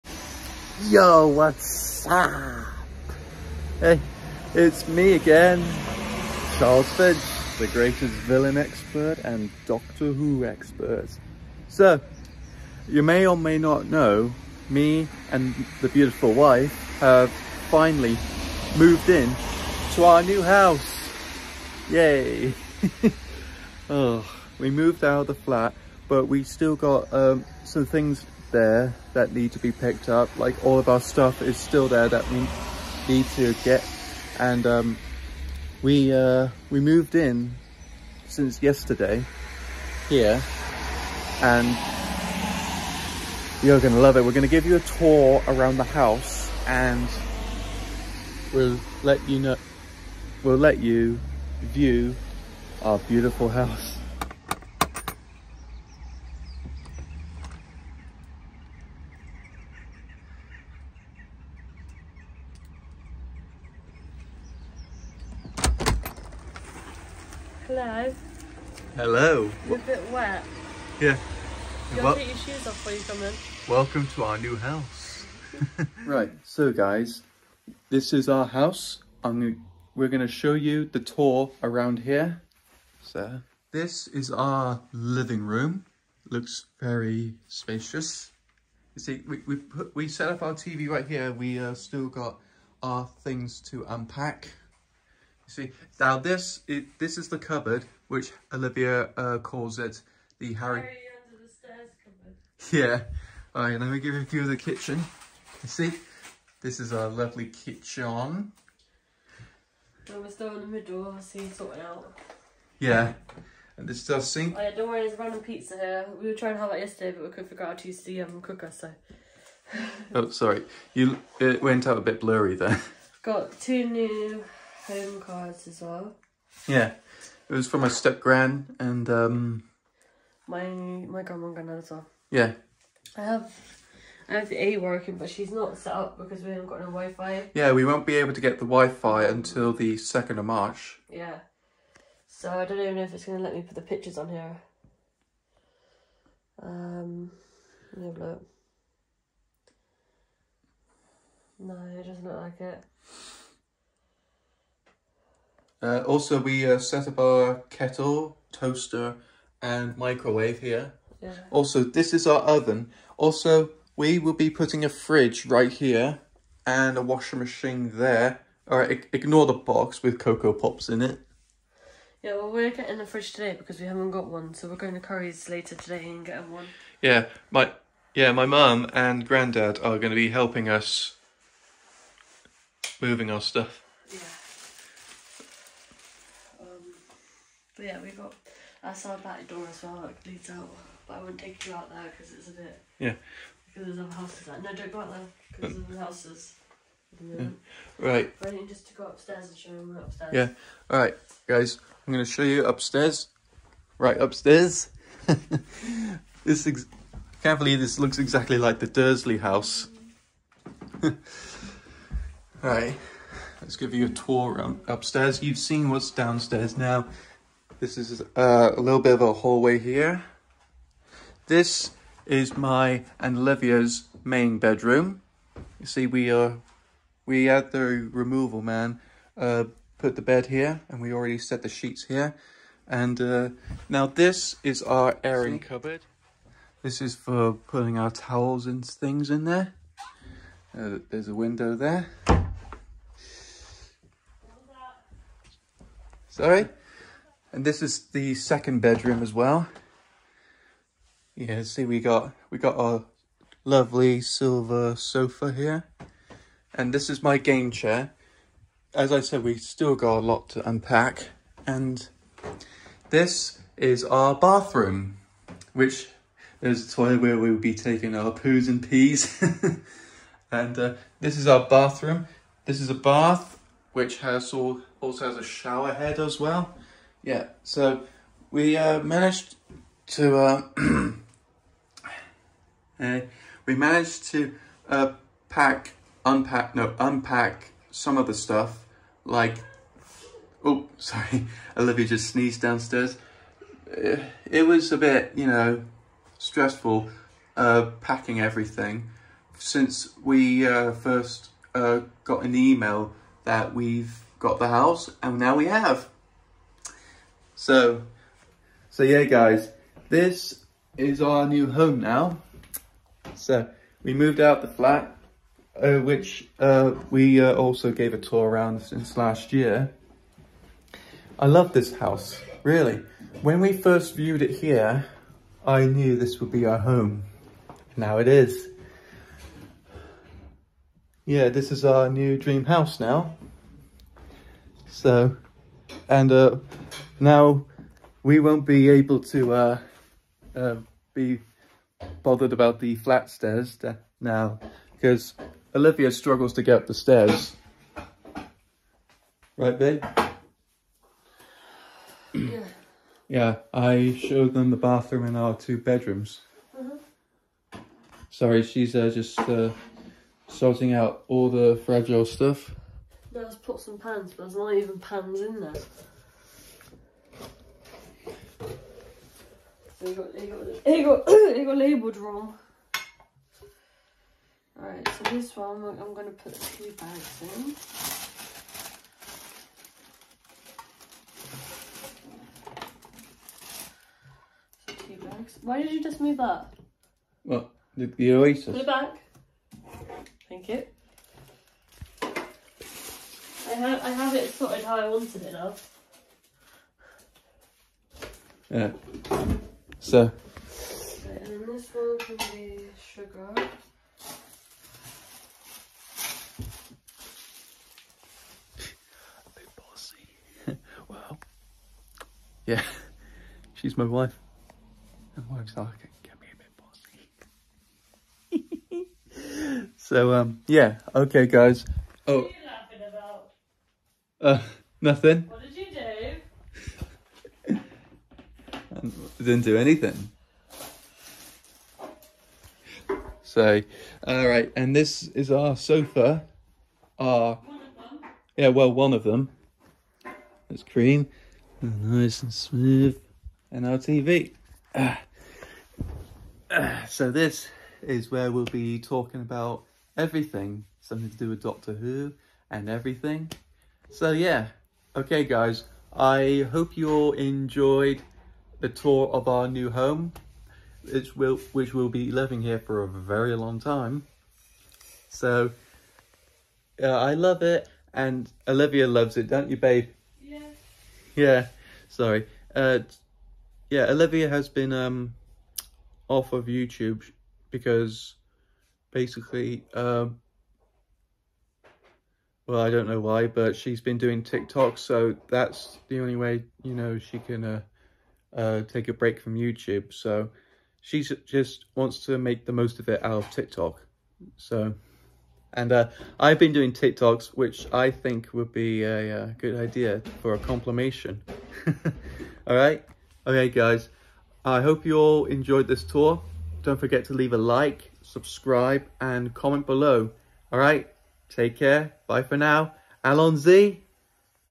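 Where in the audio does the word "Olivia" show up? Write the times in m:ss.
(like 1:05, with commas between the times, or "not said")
1:38, 4:51, 5:45, 7:48, 7:54.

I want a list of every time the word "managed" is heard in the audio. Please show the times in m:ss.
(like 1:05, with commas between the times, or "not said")
4:39, 4:43.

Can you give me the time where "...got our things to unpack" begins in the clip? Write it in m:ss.
1:32.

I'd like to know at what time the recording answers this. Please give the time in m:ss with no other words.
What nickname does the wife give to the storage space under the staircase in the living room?
1:40.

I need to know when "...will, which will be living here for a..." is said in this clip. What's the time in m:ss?
7:41.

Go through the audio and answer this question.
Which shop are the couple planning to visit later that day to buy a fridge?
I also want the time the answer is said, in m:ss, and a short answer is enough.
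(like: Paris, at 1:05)
Currys, at 2:54.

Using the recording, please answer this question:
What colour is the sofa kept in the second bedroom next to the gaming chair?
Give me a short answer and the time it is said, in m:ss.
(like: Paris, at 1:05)
Silver, at 4:14.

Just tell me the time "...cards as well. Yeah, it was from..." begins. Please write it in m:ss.
2:05.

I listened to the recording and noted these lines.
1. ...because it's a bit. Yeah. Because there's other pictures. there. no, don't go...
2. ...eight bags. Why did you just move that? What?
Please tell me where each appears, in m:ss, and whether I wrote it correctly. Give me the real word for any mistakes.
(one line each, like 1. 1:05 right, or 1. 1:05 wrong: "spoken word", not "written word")
1. 3:12 wrong: "houses", not "pictures"
2. 6:25 wrong: "two", not "eight".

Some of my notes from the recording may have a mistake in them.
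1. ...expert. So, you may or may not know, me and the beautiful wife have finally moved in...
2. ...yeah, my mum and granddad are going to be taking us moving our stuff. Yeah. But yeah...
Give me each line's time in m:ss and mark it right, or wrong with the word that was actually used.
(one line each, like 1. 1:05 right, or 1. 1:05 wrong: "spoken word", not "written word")
1. 0:10 right
2. 2:58 wrong: "helping", not "taking".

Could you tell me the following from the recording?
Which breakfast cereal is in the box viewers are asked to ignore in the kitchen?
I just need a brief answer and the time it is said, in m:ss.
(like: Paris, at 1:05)
Cocoa Pops, at 2:50.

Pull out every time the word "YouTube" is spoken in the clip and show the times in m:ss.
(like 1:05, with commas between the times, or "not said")
7:56, 8:09.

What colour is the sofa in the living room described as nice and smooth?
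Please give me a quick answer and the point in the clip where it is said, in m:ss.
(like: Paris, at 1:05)
Cream, at 7:20.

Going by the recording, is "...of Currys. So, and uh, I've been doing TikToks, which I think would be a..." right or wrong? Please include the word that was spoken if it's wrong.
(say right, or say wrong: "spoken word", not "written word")
wrong: "TikTok", not "Currys".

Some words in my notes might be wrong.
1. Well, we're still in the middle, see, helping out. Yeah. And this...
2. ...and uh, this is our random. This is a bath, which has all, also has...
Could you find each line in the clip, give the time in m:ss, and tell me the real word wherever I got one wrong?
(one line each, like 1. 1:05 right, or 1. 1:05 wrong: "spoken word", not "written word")
1. 1:50 wrong: "sorting", not "helping"
2. 4:30 wrong: "bathroom", not "random".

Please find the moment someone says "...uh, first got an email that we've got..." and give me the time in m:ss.
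5:00.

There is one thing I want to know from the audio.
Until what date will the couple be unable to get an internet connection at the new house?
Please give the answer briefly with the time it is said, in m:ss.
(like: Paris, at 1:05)
2 March, at 2:19.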